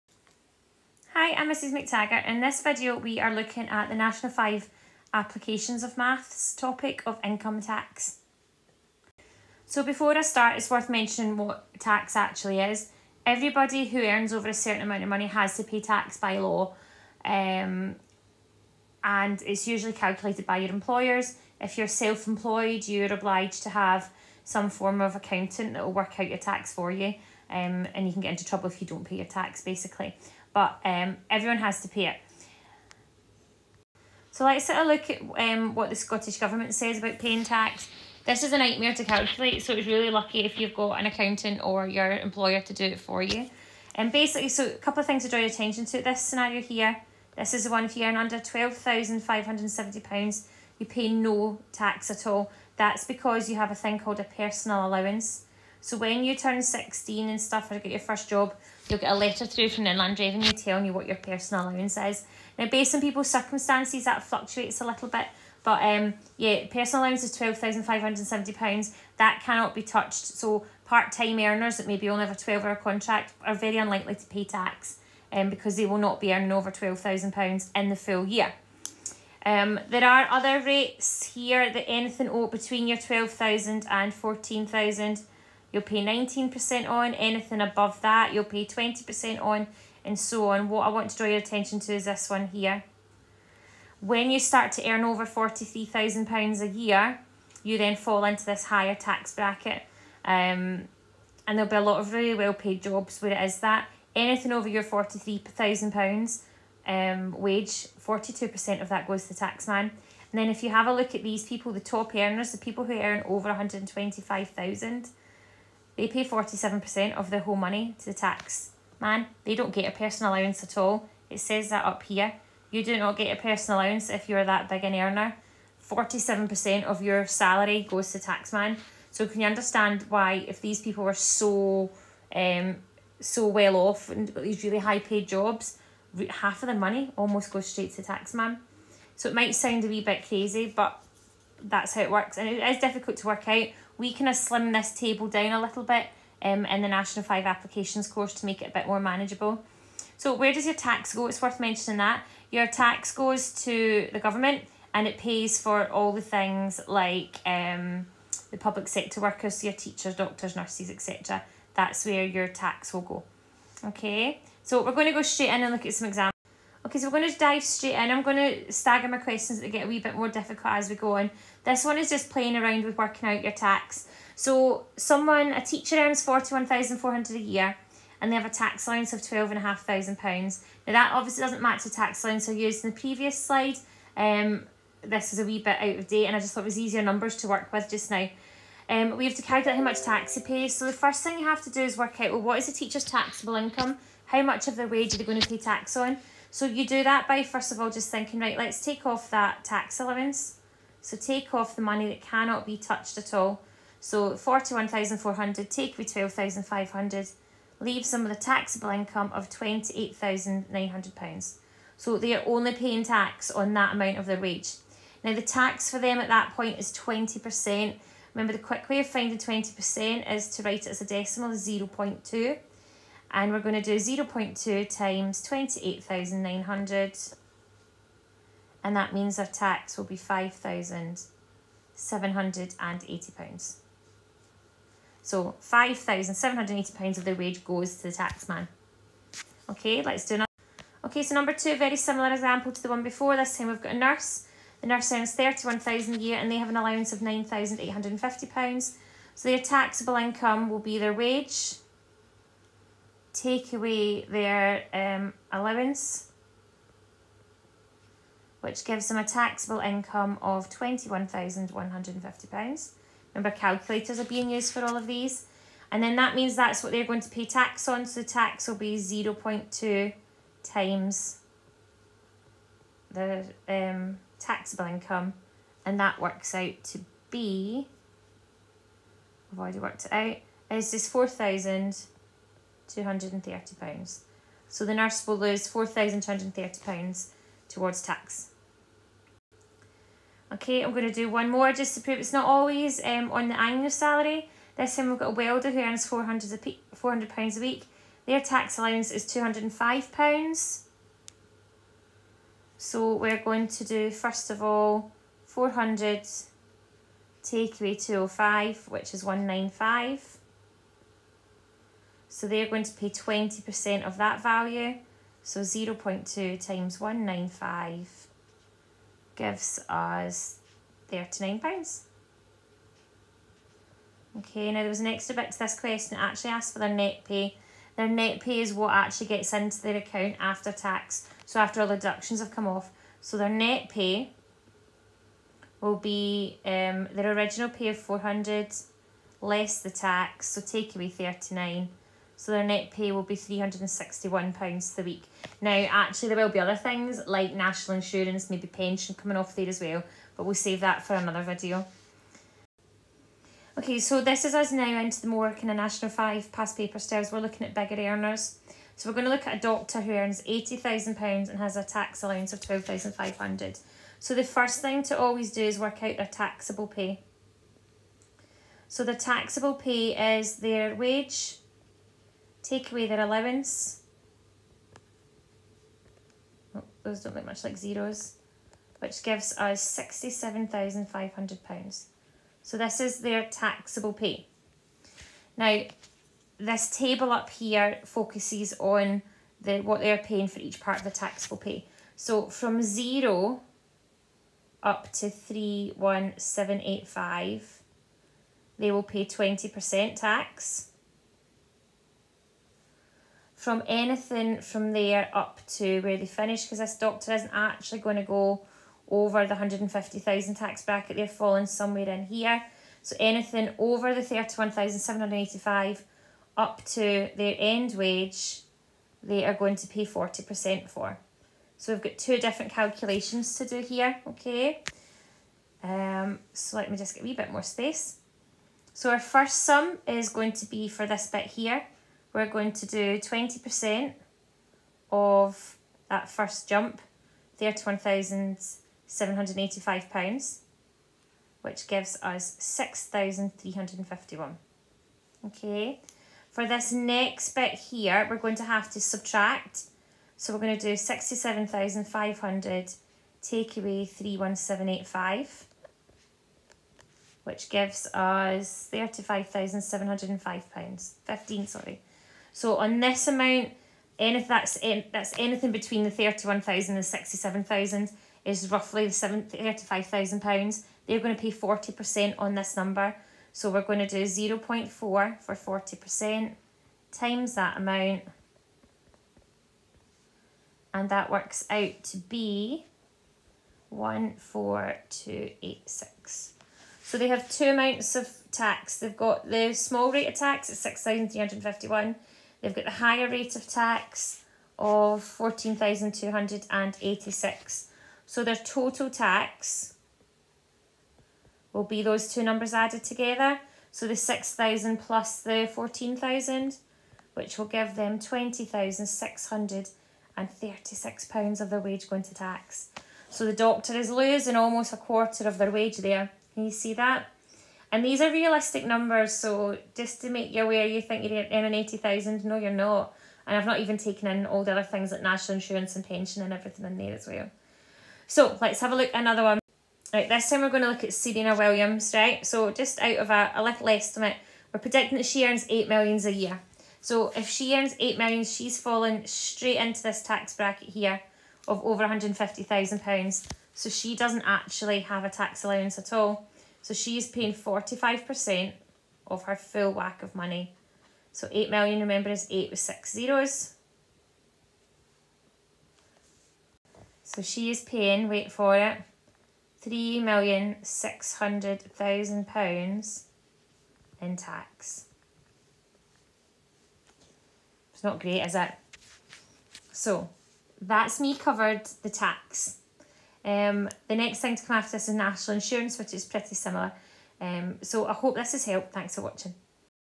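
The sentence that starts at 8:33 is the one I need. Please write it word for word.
So the doctor is losing almost a quarter of their wage there.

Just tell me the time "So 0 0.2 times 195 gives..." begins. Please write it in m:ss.
5:15.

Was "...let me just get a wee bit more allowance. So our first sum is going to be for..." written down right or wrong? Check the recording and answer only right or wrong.
wrong.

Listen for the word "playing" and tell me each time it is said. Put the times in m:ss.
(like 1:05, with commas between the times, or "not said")
2:52.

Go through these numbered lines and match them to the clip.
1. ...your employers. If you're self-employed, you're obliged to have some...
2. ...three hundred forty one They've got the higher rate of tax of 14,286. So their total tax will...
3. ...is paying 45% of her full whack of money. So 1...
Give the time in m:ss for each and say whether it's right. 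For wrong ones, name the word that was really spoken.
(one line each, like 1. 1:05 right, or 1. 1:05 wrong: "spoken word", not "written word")
1. 0:20 right
2. 8:11 wrong: "fifty", not "forty"
3. 9:07 wrong: "8", not "1".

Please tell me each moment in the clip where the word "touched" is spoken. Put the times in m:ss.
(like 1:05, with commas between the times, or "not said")
1:09, 3:22.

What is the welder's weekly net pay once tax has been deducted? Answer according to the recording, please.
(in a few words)
£361.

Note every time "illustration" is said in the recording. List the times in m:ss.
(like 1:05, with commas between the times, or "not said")
not said.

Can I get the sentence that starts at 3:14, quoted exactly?
How much of their wage are they going to pay tax on?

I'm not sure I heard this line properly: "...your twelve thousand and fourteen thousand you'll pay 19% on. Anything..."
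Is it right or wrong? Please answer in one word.
right.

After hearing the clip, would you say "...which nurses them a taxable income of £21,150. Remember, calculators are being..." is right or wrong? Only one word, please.
wrong.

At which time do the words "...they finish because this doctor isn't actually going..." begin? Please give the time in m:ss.
6:46.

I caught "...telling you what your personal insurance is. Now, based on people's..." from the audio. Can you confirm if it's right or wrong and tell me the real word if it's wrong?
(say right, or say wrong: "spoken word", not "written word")
wrong: "allowance", not "insurance".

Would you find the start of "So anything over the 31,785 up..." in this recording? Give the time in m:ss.
6:53.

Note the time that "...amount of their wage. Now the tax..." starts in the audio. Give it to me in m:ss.
3:33.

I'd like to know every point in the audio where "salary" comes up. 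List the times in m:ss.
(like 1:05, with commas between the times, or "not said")
2:07, 4:53.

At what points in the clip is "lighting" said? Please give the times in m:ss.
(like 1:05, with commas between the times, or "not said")
not said.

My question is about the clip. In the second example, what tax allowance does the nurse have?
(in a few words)
£9,850.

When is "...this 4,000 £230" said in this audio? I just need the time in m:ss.
4:40.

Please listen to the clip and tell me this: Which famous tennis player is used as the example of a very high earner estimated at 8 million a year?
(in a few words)
Serena Williams.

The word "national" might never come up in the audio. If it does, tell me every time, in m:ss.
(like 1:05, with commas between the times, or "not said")
0:03, 2:26, 5:47, 5:55, 8:45, 9:35.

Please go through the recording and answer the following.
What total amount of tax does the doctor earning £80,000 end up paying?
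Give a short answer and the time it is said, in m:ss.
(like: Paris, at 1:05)
£20,636, at 8:28.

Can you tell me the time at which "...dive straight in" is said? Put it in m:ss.
2:47.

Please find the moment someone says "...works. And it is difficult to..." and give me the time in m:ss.
2:22.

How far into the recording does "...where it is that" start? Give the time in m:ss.
1:43.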